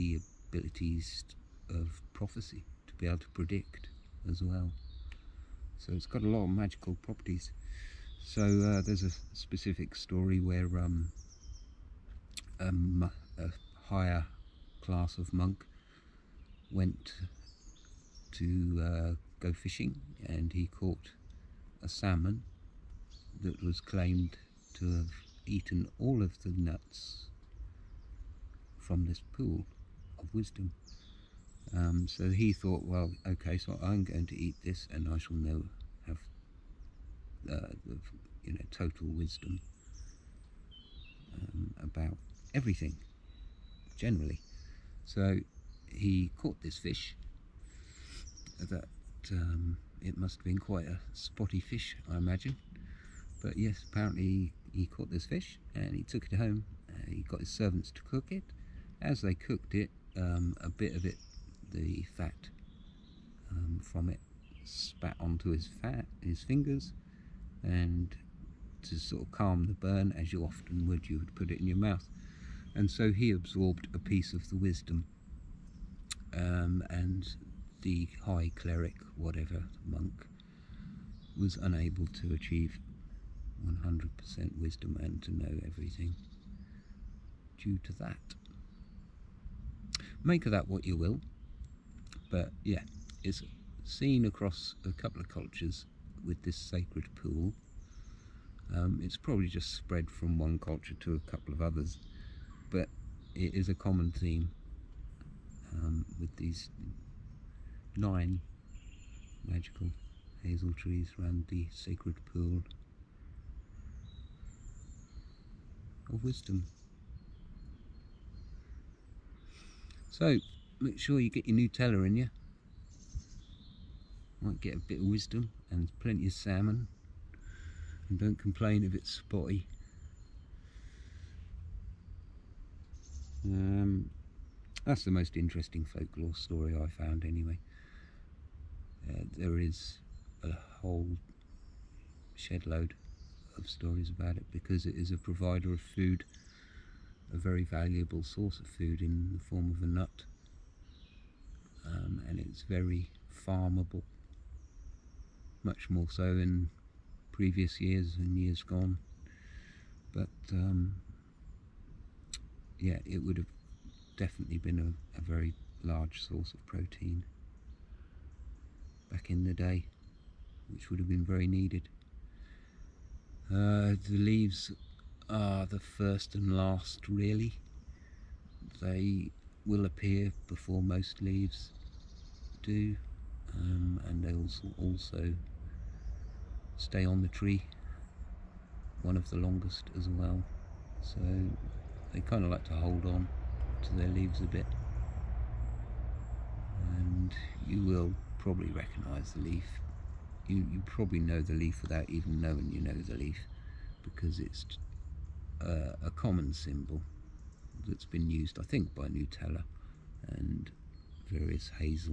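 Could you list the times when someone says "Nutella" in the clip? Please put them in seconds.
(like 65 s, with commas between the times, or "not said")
121 s, 209 s.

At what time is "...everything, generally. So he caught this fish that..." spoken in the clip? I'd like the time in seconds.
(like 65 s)
42 s.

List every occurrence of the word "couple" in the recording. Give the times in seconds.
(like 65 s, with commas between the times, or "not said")
94 s, 101 s.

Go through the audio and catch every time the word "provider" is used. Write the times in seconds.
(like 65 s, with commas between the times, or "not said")
145 s.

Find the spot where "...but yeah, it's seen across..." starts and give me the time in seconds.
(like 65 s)
92 s.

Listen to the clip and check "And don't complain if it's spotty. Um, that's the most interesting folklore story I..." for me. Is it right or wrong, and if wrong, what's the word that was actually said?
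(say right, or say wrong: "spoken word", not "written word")
right.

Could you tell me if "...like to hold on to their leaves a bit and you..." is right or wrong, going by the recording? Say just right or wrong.
right.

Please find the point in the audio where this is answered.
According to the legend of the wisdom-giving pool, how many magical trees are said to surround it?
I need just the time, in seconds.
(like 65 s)
107 s.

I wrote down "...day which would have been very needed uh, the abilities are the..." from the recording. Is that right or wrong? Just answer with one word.
wrong.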